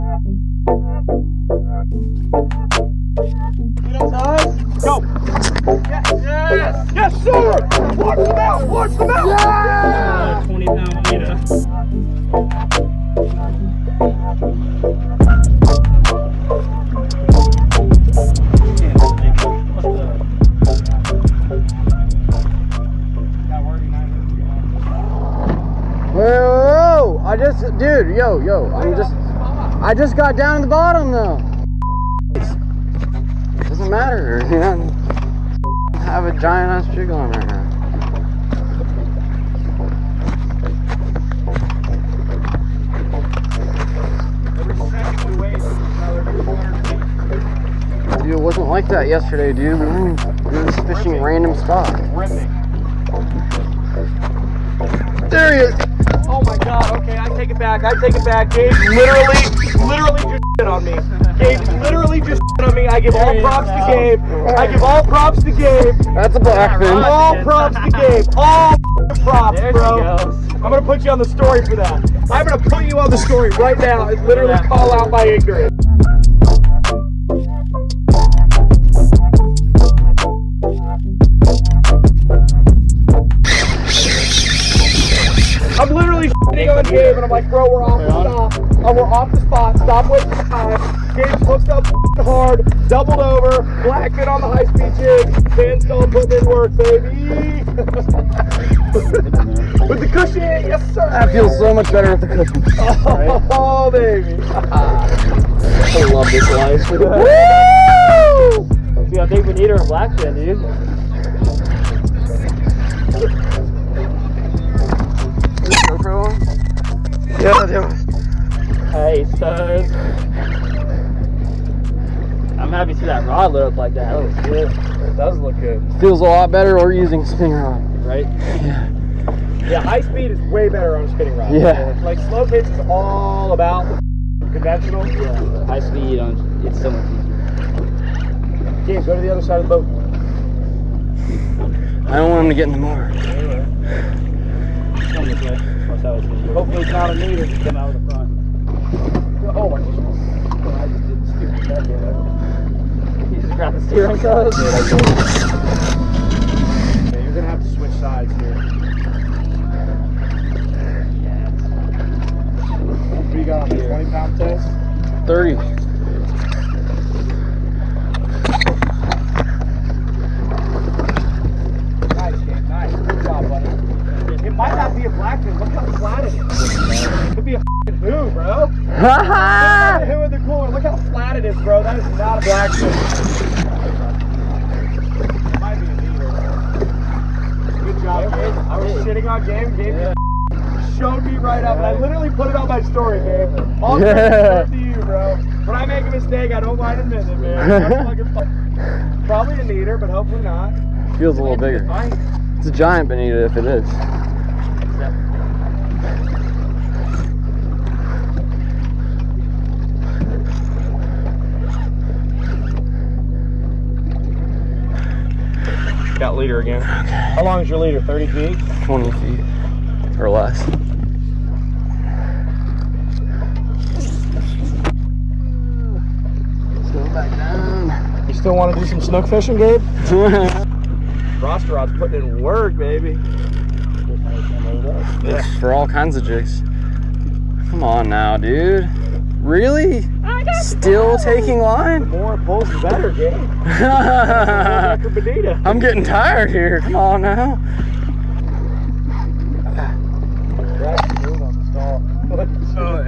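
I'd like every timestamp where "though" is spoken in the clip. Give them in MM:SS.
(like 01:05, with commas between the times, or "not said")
00:31.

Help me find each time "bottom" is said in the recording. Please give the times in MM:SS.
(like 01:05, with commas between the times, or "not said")
00:30.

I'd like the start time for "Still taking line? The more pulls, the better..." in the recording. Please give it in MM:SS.
04:00.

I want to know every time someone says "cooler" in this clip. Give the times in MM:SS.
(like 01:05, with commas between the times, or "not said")
03:00.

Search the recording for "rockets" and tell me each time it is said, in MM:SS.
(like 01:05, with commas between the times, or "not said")
not said.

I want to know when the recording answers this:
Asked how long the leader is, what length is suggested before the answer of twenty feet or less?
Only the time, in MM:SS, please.
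03:37.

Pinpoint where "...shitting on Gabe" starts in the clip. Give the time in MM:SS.
03:09.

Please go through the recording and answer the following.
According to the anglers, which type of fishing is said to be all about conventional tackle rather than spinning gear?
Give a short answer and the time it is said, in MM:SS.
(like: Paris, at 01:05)
Slow pitch, at 02:12.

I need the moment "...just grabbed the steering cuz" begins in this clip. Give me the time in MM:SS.
02:33.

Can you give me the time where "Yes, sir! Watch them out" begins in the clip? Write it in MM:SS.
00:06.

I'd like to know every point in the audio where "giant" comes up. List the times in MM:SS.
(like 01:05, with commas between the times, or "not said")
00:36, 03:22.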